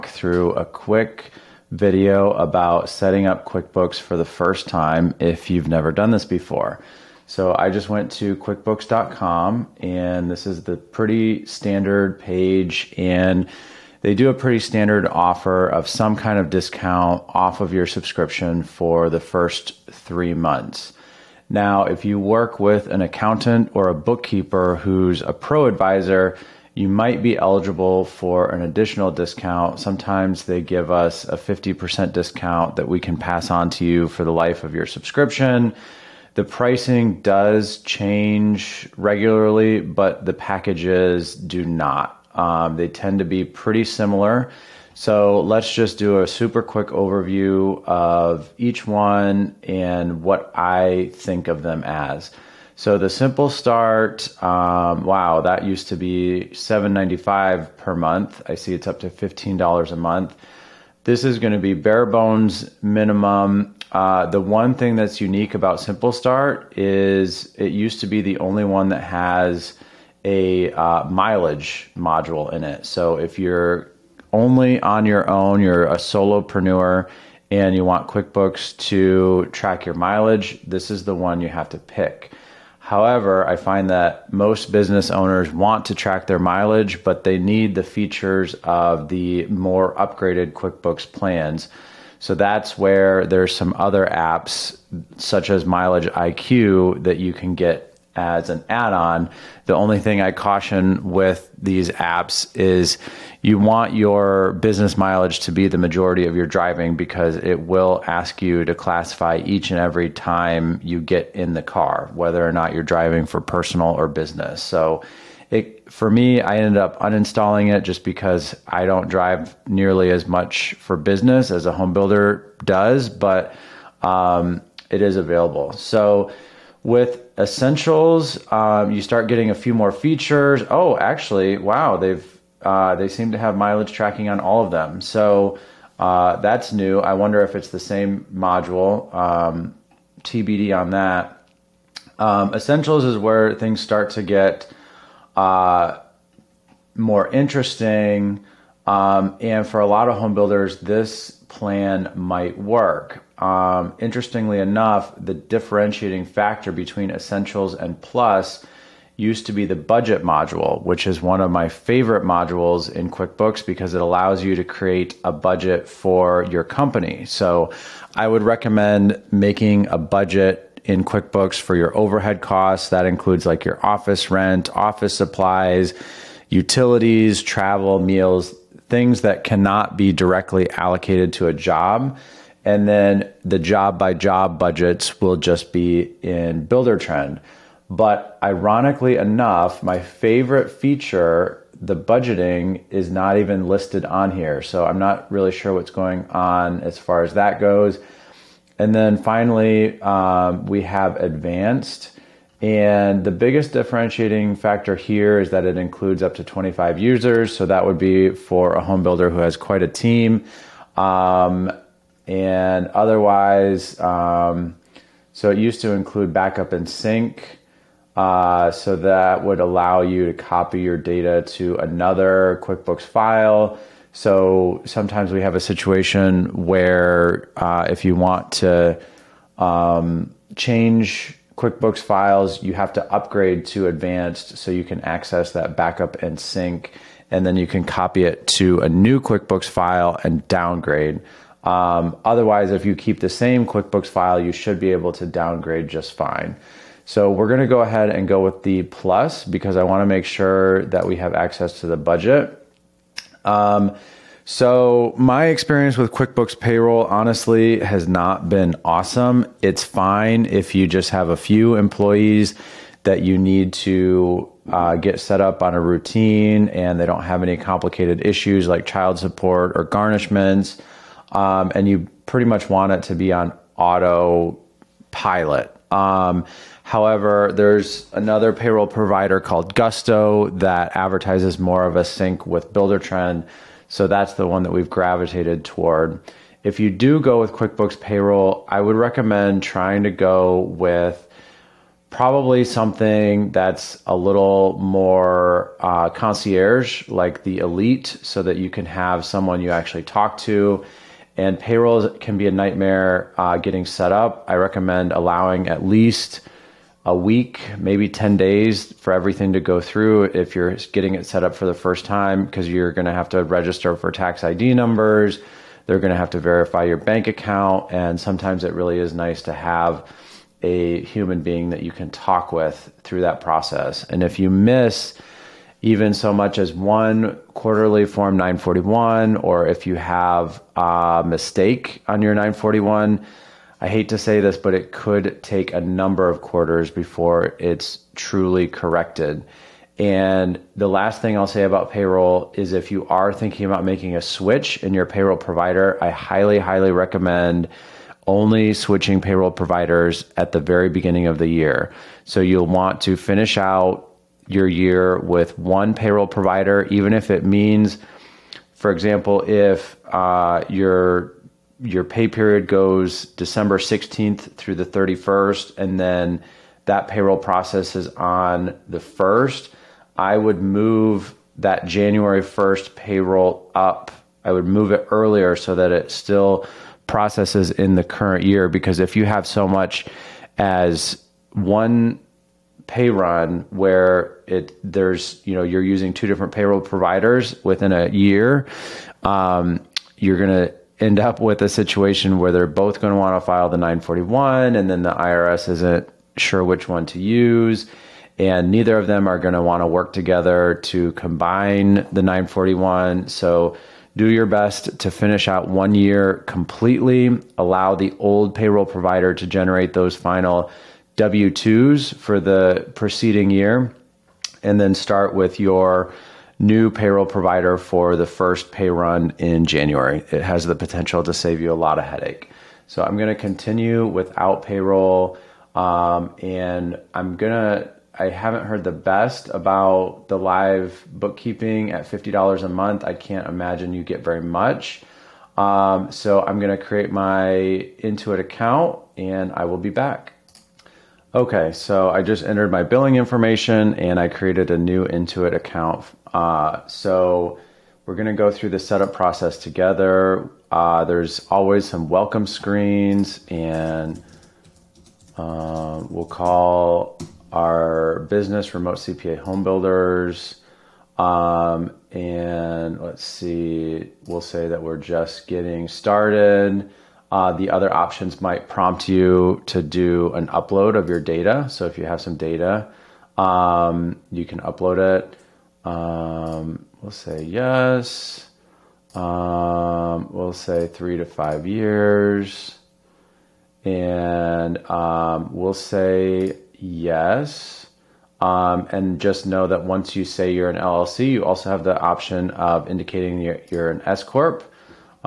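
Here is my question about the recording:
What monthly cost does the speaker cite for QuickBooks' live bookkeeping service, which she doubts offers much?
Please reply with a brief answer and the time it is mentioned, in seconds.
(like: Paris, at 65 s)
$50, at 432 s.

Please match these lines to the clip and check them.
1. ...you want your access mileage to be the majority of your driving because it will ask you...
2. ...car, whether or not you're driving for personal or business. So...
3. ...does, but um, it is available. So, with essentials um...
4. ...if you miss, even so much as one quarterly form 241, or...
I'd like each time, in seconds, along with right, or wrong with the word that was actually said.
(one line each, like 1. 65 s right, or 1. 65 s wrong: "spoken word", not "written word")
1. 103 s wrong: "business", not "access"
2. 111 s right
3. 122 s right
4. 324 s wrong: "941", not "241".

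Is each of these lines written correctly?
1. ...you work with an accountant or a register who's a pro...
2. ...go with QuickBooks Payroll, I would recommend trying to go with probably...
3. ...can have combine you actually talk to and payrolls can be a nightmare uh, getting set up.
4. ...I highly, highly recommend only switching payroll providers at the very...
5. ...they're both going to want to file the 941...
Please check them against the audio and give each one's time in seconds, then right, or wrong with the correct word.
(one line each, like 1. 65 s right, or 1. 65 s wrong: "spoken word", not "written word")
1. 22 s wrong: "bookkeeper", not "register"
2. 287 s right
3. 298 s wrong: "someone", not "combine"
4. 346 s right
5. 392 s right.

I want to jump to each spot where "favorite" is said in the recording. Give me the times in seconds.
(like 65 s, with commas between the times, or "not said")
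161 s, 190 s.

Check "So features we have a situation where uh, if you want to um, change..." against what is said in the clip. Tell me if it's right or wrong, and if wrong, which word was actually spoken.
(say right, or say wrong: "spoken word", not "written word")
wrong: "sometimes", not "features".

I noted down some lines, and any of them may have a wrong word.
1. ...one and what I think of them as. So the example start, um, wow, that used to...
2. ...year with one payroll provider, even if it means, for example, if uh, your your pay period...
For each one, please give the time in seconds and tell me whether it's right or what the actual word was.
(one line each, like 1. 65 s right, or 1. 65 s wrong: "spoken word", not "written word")
1. 48 s wrong: "simple", not "example"
2. 354 s right.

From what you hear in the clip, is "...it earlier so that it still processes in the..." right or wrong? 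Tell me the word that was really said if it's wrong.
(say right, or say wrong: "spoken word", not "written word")
right.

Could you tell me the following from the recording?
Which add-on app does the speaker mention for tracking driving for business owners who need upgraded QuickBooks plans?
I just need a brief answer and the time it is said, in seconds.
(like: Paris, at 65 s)
Mileage IQ, at 95 s.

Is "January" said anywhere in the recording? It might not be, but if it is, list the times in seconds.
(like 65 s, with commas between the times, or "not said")
371 s, 419 s.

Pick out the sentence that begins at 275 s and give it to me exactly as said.
Um, however, there's another payroll provider called Gusto that advertises more of a sync with BuilderTrend.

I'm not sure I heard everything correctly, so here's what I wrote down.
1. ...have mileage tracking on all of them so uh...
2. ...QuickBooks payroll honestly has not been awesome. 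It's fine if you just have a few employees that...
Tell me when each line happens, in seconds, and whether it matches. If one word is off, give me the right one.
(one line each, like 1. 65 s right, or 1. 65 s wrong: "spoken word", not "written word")
1. 133 s right
2. 256 s right.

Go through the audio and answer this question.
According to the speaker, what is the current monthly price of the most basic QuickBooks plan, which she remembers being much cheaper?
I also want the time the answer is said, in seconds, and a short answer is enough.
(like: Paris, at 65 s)
$15 a month, at 59 s.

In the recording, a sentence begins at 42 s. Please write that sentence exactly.
Um, they tend to be pretty similar.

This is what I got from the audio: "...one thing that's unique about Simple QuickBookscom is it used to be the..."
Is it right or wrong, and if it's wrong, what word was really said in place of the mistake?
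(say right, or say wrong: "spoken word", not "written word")
wrong: "Start", not "QuickBookscom".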